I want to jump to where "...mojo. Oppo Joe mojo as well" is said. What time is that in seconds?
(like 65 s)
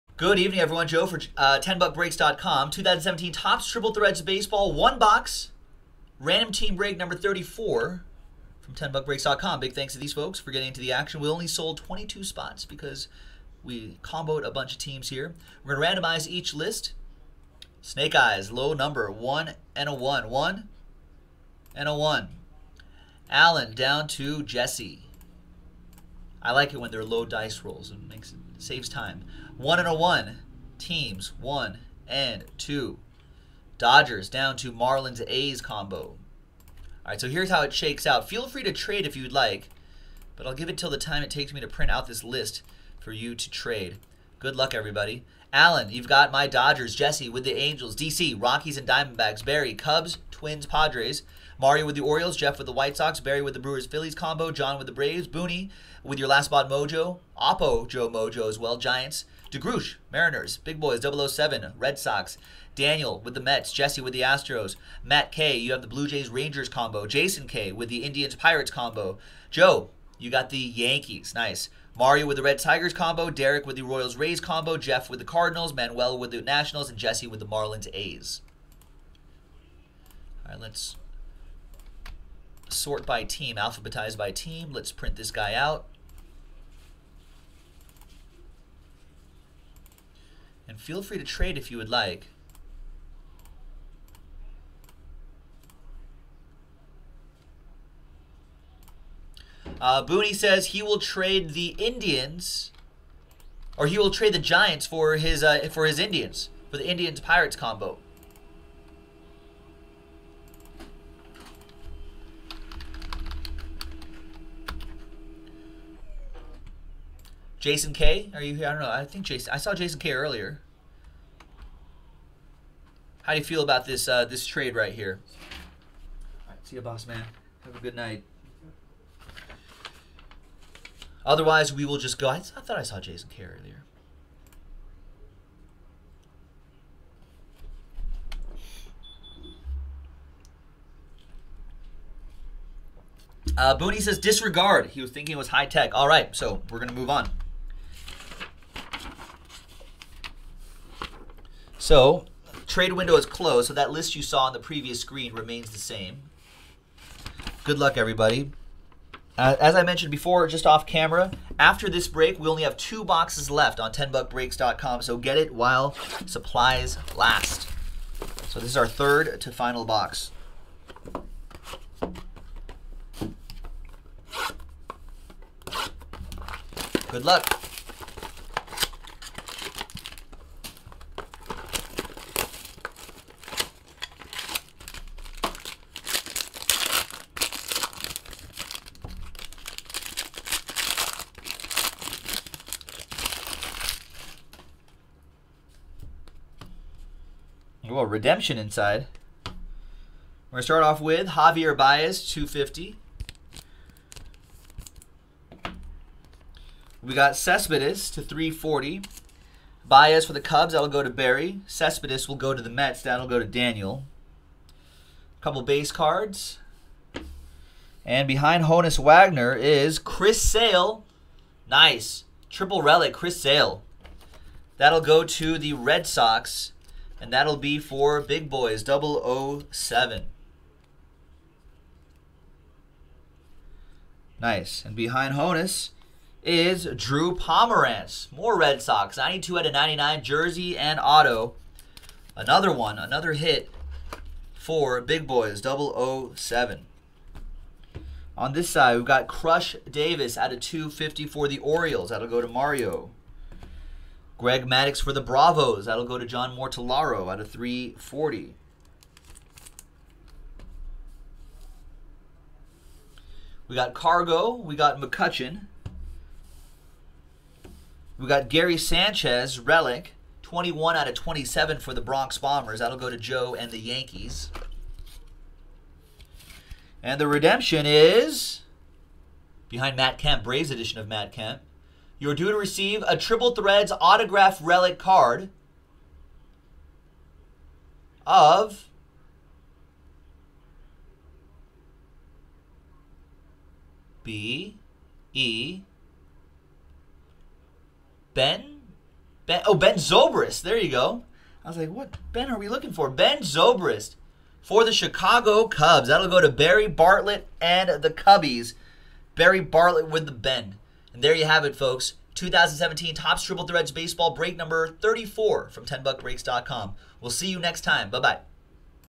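56 s.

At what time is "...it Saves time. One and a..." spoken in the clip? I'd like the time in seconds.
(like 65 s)
28 s.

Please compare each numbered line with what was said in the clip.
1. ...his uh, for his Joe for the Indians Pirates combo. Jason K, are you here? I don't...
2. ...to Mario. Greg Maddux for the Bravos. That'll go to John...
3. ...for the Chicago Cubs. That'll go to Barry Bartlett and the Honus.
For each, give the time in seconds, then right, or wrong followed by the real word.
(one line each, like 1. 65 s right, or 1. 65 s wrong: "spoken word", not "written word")
1. 105 s wrong: "Indians", not "Joe"
2. 252 s right
3. 304 s wrong: "Cubbies", not "Honus".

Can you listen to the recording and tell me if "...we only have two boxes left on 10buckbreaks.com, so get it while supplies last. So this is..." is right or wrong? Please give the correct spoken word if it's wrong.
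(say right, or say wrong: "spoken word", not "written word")
right.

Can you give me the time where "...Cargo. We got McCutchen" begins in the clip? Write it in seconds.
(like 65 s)
263 s.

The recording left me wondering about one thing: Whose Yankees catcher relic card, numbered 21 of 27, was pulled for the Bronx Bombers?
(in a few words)
Gary Sanchez.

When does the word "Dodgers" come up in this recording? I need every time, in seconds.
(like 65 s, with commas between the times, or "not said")
33 s, 46 s.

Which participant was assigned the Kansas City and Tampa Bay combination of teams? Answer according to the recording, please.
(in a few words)
Derek.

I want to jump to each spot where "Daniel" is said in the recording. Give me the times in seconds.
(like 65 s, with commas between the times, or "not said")
62 s, 213 s.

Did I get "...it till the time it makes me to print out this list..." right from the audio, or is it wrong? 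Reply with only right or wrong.
wrong.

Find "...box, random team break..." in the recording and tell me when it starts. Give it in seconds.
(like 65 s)
4 s.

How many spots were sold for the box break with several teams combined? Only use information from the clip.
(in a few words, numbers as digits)
22.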